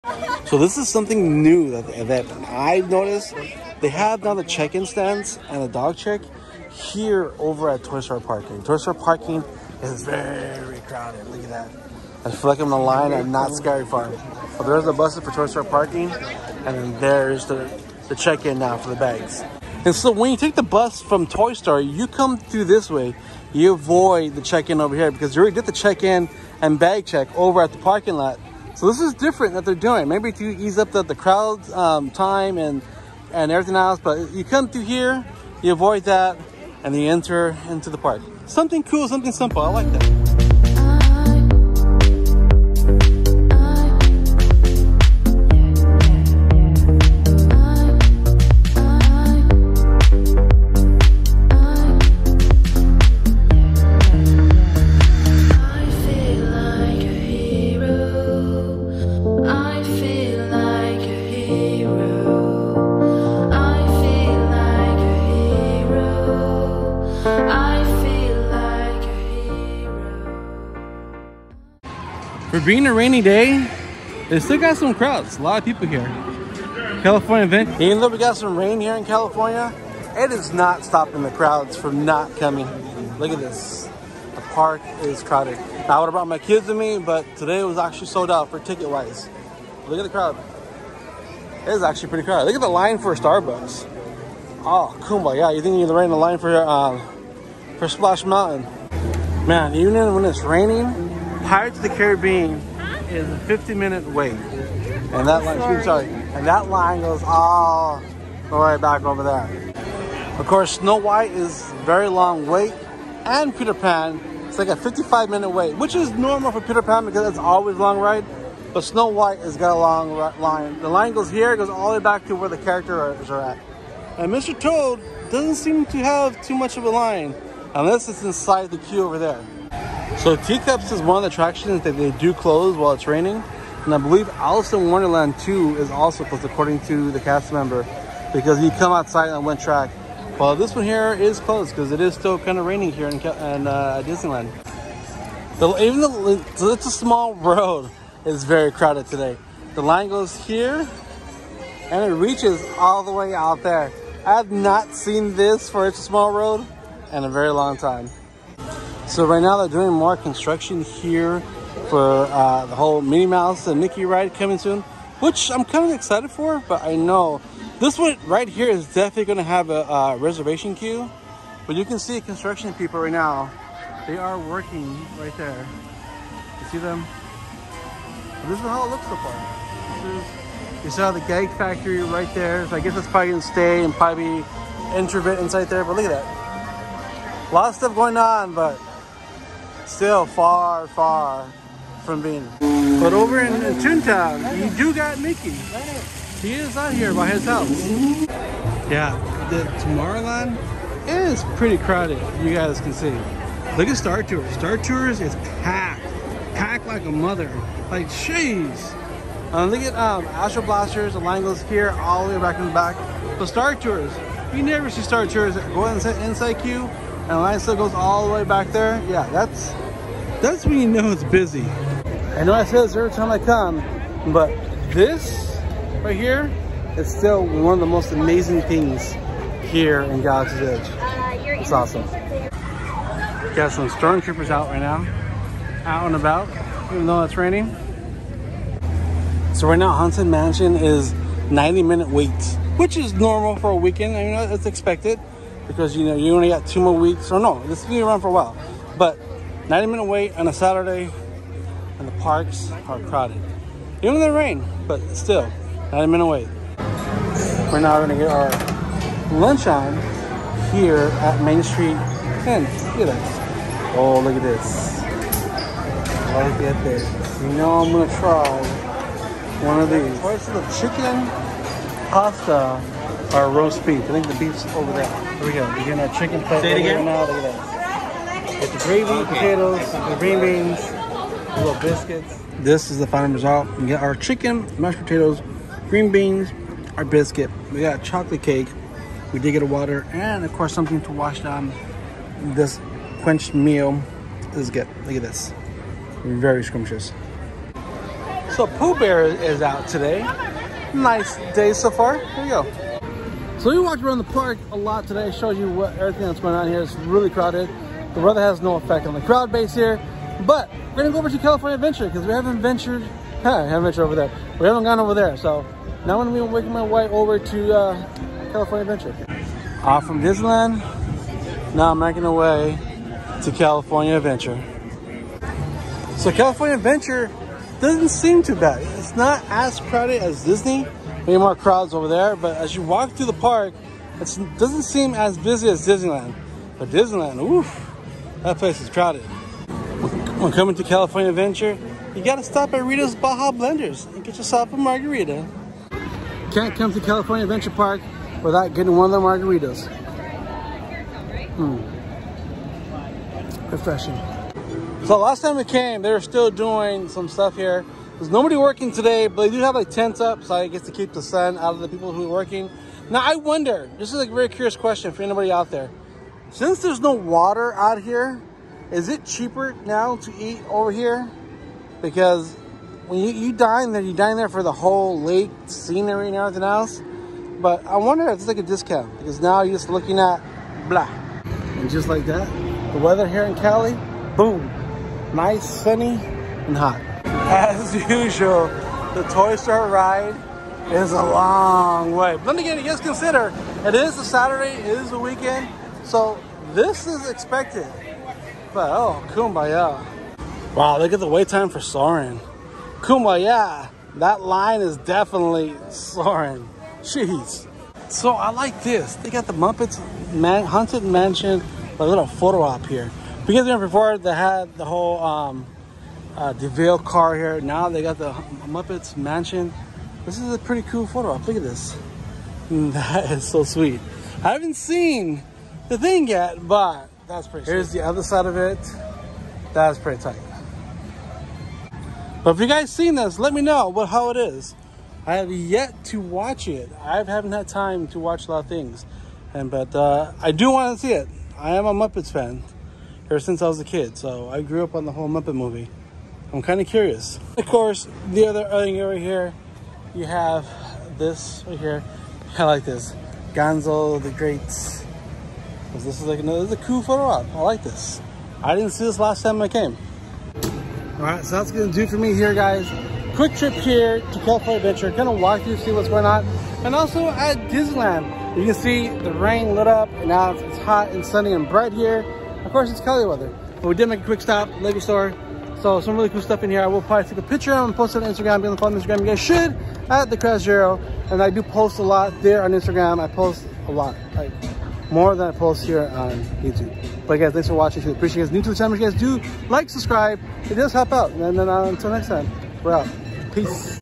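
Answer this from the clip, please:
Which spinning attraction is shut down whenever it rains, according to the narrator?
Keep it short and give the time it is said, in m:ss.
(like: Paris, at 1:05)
Teacups, at 2:10.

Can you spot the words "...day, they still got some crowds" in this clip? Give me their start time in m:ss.
1:13.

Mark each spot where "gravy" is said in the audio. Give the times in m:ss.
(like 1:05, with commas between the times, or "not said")
4:38.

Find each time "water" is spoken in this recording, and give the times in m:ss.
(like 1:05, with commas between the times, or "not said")
4:49, 6:07.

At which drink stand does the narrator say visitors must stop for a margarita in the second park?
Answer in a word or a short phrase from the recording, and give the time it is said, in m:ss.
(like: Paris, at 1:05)
Rita's Baja Blenders, at 5:42.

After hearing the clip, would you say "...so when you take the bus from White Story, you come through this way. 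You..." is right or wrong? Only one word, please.
wrong.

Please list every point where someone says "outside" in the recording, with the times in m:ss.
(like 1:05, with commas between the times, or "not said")
2:18.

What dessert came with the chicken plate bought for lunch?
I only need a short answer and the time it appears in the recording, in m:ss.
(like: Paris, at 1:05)
Chocolate cake, at 4:48.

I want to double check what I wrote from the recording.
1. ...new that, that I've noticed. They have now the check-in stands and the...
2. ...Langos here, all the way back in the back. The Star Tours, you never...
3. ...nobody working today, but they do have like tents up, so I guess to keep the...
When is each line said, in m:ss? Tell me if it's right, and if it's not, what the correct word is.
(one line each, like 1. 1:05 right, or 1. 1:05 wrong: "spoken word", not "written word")
1. 0:01 right
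2. 3:31 right
3. 5:58 right.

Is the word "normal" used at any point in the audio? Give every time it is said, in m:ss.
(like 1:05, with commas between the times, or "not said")
1:56, 4:03.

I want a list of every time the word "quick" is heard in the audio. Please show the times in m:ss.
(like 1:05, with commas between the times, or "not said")
7:43, 7:54.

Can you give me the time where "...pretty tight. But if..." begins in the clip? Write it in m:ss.
7:09.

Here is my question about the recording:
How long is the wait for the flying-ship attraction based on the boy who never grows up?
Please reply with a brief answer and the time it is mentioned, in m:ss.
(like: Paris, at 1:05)
55 minutes, at 1:54.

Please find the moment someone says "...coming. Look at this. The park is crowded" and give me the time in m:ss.
1:22.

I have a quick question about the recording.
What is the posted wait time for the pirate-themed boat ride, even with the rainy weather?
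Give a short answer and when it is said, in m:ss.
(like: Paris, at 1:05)
50 minutes, at 1:43.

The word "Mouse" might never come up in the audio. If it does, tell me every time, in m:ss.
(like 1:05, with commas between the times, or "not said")
2:43.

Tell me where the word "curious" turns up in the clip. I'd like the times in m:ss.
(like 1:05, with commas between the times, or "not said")
6:04, 7:26.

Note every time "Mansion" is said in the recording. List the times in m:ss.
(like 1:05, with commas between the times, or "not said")
4:00, 6:51, 6:59.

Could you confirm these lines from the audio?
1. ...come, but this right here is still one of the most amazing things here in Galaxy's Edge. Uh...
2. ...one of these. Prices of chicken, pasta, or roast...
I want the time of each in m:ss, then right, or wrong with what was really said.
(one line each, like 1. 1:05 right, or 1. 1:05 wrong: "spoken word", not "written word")
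1. 3:43 right
2. 4:29 right.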